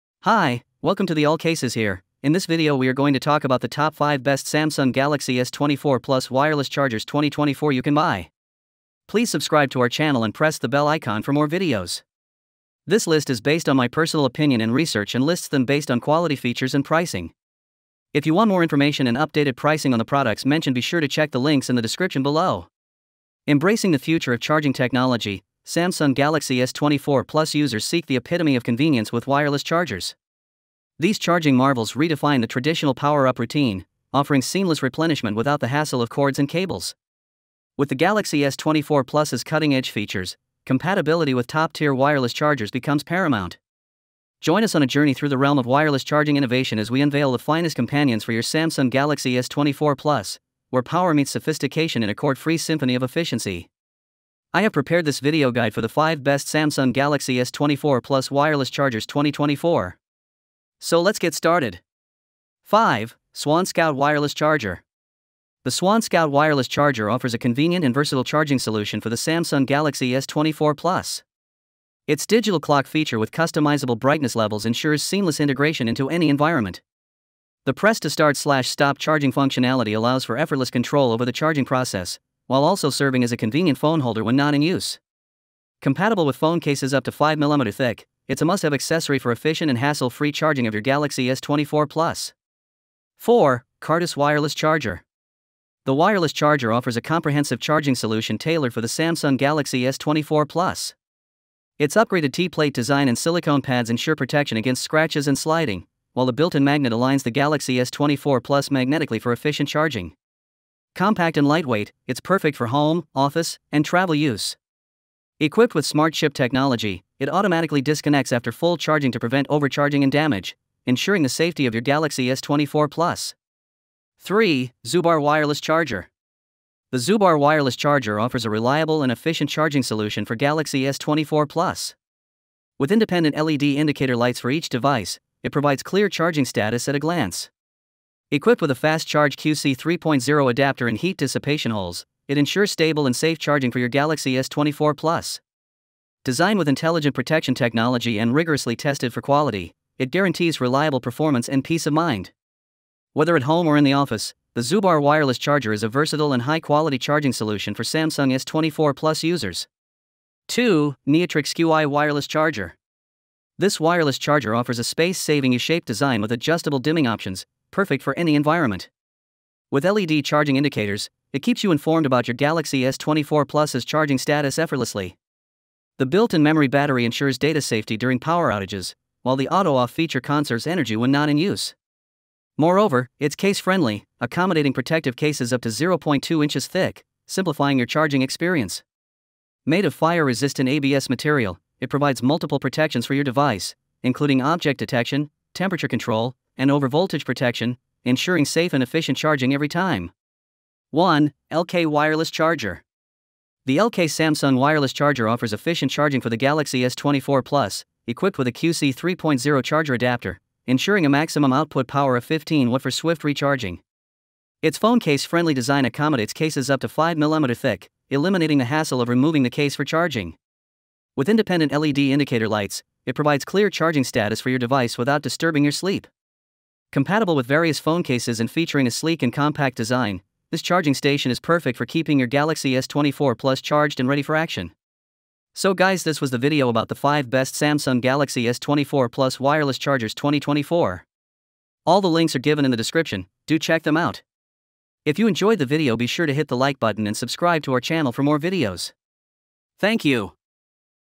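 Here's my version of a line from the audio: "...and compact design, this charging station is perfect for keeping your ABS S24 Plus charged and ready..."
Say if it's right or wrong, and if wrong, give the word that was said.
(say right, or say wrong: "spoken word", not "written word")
wrong: "Galaxy", not "ABS".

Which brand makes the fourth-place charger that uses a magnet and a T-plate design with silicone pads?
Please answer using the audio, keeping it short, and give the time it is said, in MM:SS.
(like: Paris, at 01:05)
Kartice, at 01:33.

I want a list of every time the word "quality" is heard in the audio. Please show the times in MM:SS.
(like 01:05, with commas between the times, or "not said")
00:15, 02:29, 02:36.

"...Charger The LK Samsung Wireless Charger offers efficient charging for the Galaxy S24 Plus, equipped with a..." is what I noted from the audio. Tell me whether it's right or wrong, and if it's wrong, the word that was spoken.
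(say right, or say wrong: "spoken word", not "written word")
right.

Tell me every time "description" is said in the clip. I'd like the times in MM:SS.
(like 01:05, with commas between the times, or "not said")
00:21, 04:02.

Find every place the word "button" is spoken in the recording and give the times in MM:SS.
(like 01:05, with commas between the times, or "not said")
04:06.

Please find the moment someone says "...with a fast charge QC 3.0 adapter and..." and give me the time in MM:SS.
02:18.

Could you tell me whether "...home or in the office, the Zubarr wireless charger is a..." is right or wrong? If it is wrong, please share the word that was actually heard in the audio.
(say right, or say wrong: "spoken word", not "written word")
right.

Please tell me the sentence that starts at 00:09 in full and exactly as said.
Please subscribe to our channel and press the bell icon for more videos.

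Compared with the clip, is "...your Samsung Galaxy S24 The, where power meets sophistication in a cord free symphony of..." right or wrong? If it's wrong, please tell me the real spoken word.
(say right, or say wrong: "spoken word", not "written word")
wrong: "Plus", not "The".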